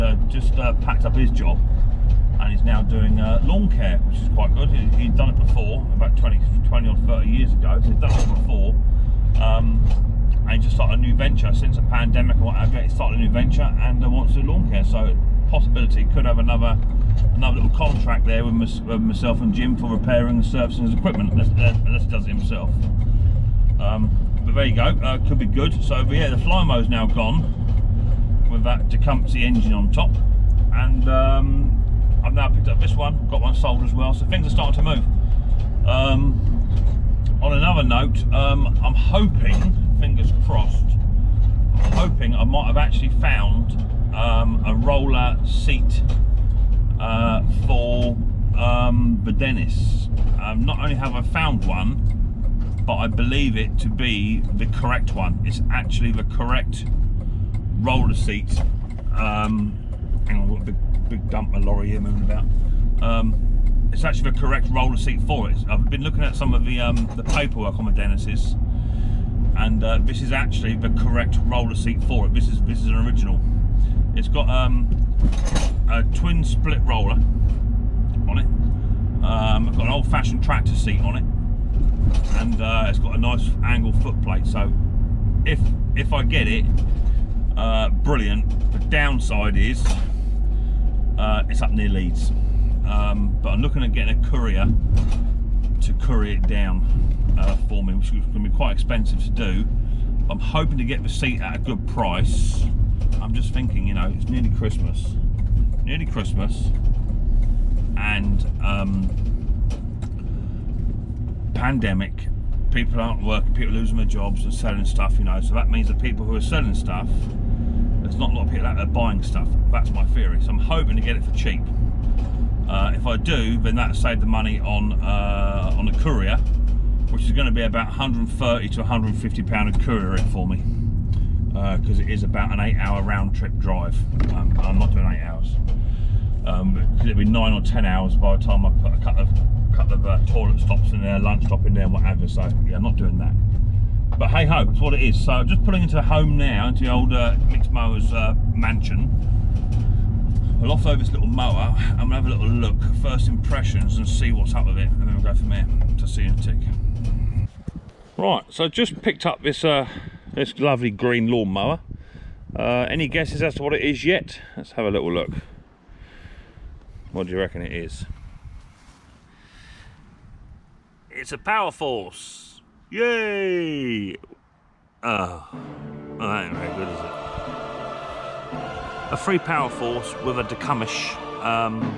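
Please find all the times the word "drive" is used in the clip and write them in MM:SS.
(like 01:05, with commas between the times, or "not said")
02:13.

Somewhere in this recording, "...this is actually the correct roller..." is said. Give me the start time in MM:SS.
01:10.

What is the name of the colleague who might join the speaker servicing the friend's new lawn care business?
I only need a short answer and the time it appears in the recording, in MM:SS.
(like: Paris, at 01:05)
Jim, at 00:19.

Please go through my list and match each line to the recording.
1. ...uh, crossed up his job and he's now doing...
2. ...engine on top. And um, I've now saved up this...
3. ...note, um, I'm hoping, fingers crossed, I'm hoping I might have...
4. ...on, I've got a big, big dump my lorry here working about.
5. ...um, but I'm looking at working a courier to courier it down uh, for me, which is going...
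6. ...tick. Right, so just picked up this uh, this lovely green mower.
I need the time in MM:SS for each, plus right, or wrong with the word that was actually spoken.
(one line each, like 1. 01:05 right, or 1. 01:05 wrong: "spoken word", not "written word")
1. 00:00 wrong: "packed", not "crossed"
2. 00:29 wrong: "picked", not "saved"
3. 00:37 right
4. 01:00 wrong: "moving", not "working"
5. 01:32 wrong: "getting", not "working"
6. 02:36 wrong: "lawnmower", not "mower".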